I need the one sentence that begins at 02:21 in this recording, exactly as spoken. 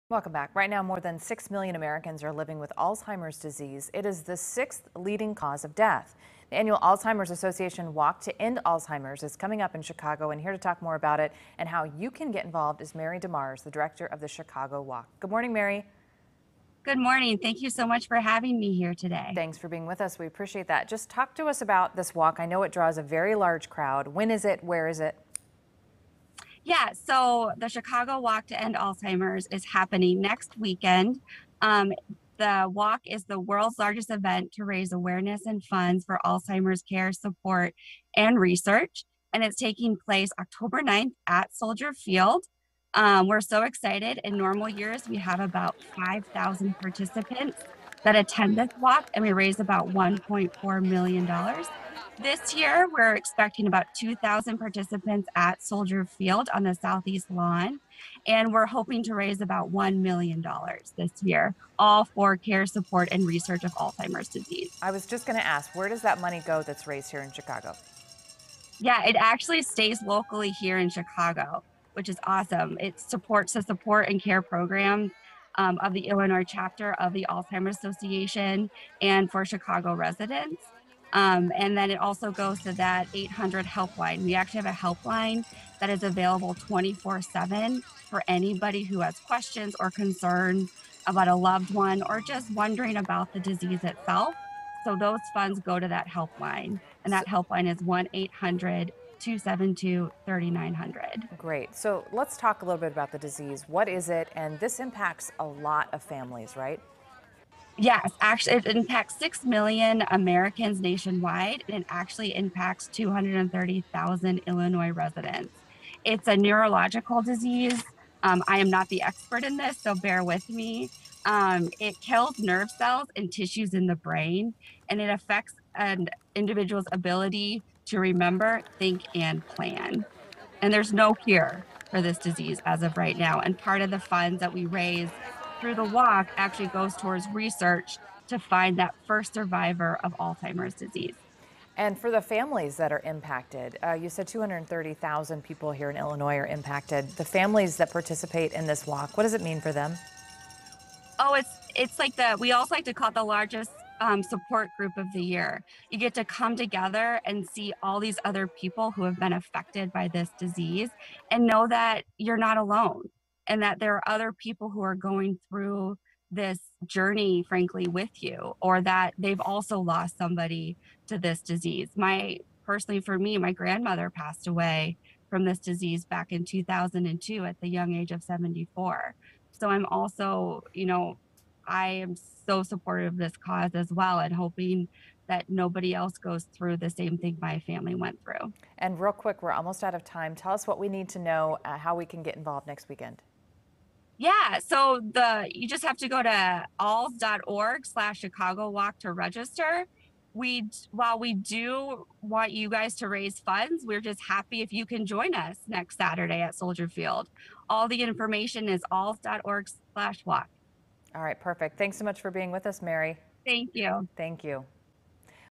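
And for the families that are impacted, uh, you said 230,000 people here in Illinois are impacted.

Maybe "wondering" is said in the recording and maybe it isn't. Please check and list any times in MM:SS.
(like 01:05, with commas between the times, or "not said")
01:32.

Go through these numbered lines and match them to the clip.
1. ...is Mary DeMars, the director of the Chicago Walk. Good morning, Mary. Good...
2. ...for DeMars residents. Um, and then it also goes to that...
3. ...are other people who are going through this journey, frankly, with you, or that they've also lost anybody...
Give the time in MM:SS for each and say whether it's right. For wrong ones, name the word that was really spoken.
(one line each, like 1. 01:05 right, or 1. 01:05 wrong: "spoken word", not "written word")
1. 00:12 right
2. 01:19 wrong: "Chicago", not "DeMars"
3. 02:43 wrong: "somebody", not "anybody".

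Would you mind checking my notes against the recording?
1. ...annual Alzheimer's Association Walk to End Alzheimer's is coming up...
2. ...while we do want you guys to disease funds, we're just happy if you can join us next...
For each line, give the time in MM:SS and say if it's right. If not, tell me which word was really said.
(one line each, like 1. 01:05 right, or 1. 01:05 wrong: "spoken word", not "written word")
1. 00:06 right
2. 03:20 wrong: "raise", not "disease".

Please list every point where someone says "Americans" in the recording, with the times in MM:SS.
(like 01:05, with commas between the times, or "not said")
00:01, 01:50.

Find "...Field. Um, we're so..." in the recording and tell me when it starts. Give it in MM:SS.
00:41.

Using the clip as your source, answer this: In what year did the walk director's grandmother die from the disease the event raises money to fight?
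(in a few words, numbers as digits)
2002.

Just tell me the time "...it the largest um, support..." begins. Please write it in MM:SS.
02:33.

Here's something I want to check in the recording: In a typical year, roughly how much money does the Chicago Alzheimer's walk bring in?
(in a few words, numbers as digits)
$1.4 million.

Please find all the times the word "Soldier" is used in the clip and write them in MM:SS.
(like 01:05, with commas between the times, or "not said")
00:41, 00:55, 03:26.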